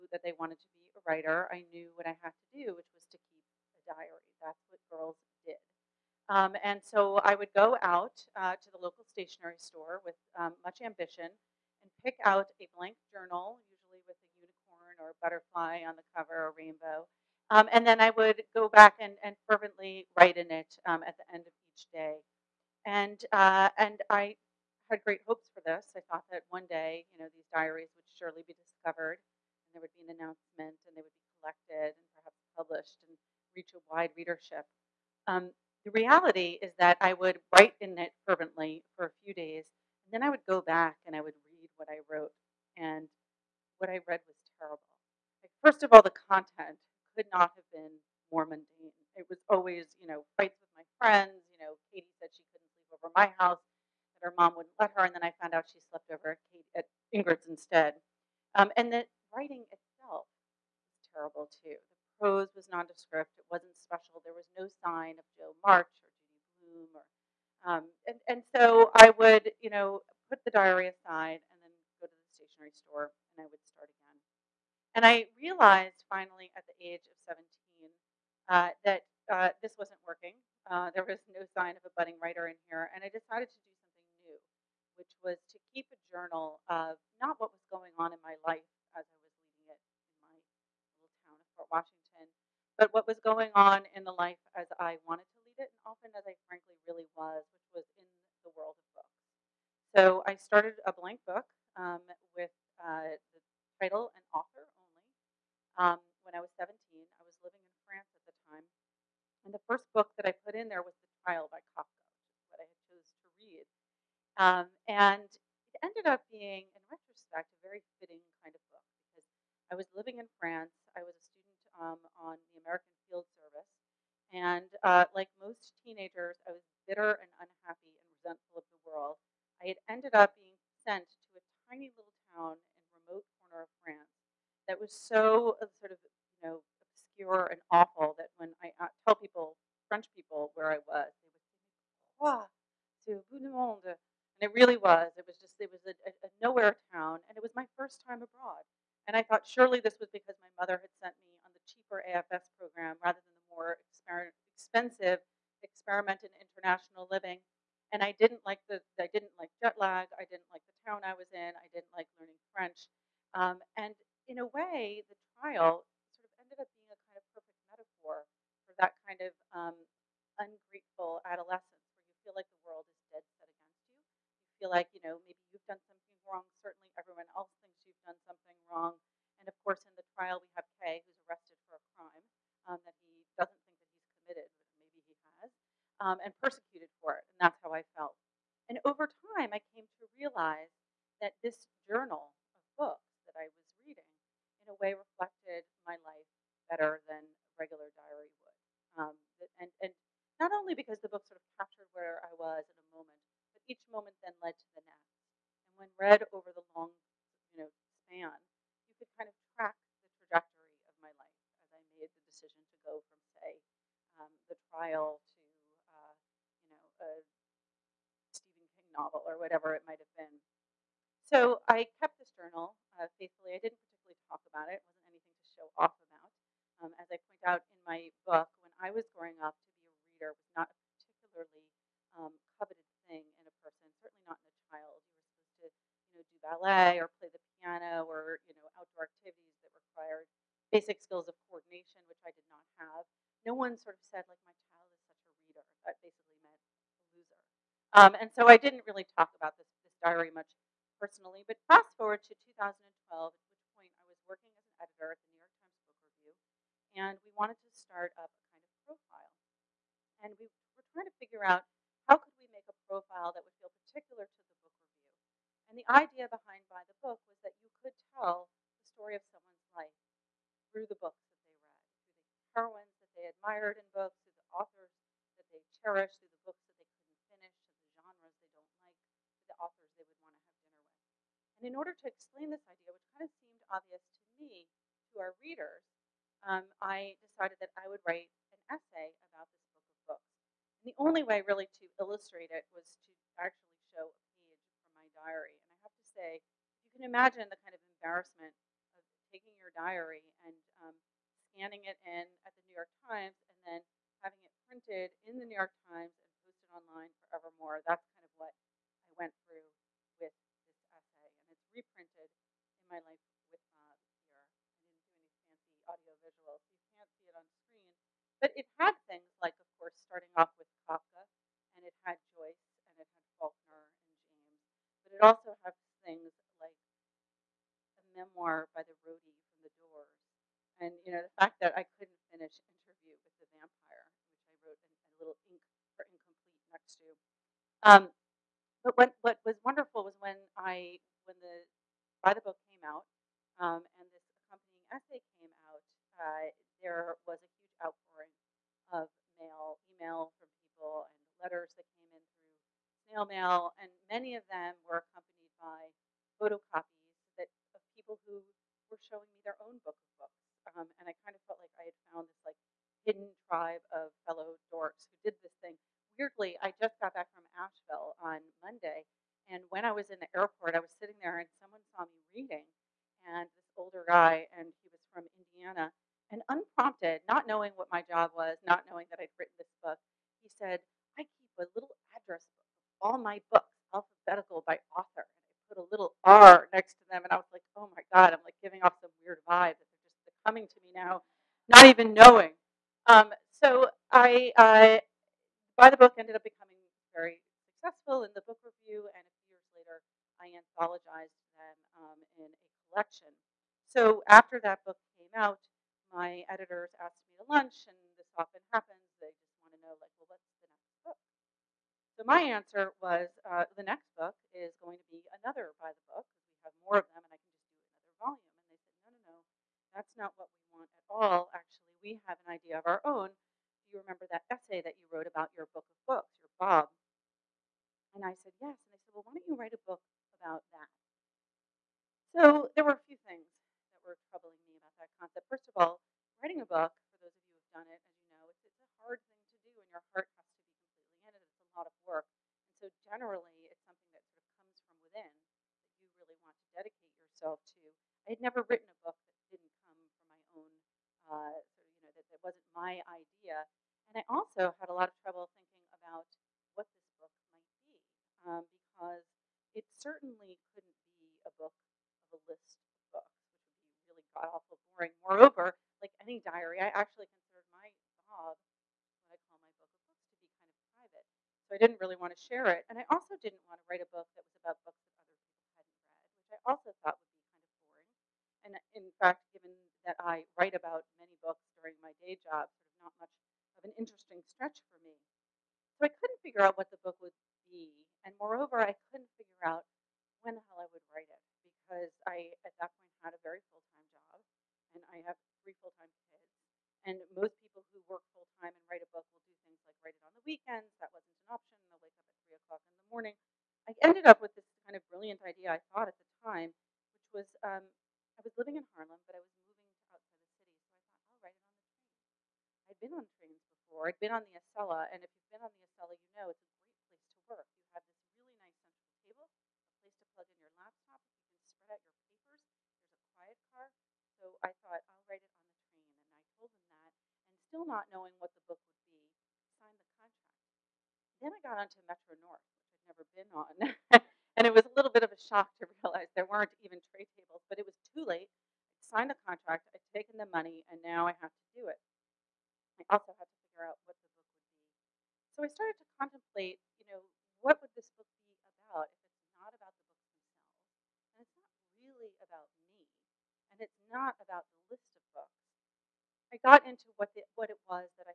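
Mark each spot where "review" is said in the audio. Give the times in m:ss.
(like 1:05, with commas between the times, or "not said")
4:16, 4:24.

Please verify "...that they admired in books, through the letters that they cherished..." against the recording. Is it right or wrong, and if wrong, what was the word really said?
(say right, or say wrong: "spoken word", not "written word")
wrong: "authors", not "letters".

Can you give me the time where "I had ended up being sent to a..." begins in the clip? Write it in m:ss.
2:09.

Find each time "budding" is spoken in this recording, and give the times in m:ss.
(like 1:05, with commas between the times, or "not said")
1:21.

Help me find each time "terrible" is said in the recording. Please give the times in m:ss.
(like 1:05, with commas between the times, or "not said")
0:44, 1:01.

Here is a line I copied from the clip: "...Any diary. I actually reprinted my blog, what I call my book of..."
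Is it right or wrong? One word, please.
wrong.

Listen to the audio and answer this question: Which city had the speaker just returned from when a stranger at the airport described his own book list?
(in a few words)
Asheville.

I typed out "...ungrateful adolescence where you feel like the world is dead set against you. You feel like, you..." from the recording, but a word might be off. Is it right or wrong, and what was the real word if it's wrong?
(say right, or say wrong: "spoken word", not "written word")
right.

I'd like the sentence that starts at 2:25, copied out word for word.
It was just it was a, a nowhere town, and it was my first time abroad.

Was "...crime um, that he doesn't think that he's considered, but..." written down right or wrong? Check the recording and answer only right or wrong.
wrong.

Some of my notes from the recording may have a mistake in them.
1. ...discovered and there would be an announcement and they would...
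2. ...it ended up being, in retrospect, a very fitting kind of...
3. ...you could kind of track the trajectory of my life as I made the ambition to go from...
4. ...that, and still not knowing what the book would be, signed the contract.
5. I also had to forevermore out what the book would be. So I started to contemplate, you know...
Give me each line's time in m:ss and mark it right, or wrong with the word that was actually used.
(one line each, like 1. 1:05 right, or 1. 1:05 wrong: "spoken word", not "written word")
1. 0:28 right
2. 1:55 right
3. 3:28 wrong: "decision", not "ambition"
4. 8:47 right
5. 9:03 wrong: "figure", not "forevermore".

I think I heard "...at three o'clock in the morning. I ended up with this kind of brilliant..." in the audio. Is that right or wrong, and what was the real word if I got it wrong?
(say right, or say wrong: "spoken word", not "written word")
right.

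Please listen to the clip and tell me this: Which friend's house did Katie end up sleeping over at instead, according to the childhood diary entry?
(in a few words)
Ingrid's.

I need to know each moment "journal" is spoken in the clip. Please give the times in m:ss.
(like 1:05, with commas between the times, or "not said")
0:13, 1:26, 3:11, 3:42.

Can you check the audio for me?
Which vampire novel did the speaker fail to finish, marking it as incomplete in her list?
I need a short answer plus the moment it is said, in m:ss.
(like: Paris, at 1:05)
Interview with the Vampire, at 5:32.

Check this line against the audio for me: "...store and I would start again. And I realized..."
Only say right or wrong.
right.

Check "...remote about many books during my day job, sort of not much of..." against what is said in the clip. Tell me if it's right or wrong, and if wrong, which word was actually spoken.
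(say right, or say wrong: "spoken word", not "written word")
wrong: "write", not "remote".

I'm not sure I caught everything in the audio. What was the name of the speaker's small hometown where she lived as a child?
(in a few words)
Port Washington.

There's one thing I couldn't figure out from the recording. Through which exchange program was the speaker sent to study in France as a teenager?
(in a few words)
American Field Service.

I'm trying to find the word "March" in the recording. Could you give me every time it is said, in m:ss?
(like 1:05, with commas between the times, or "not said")
1:05.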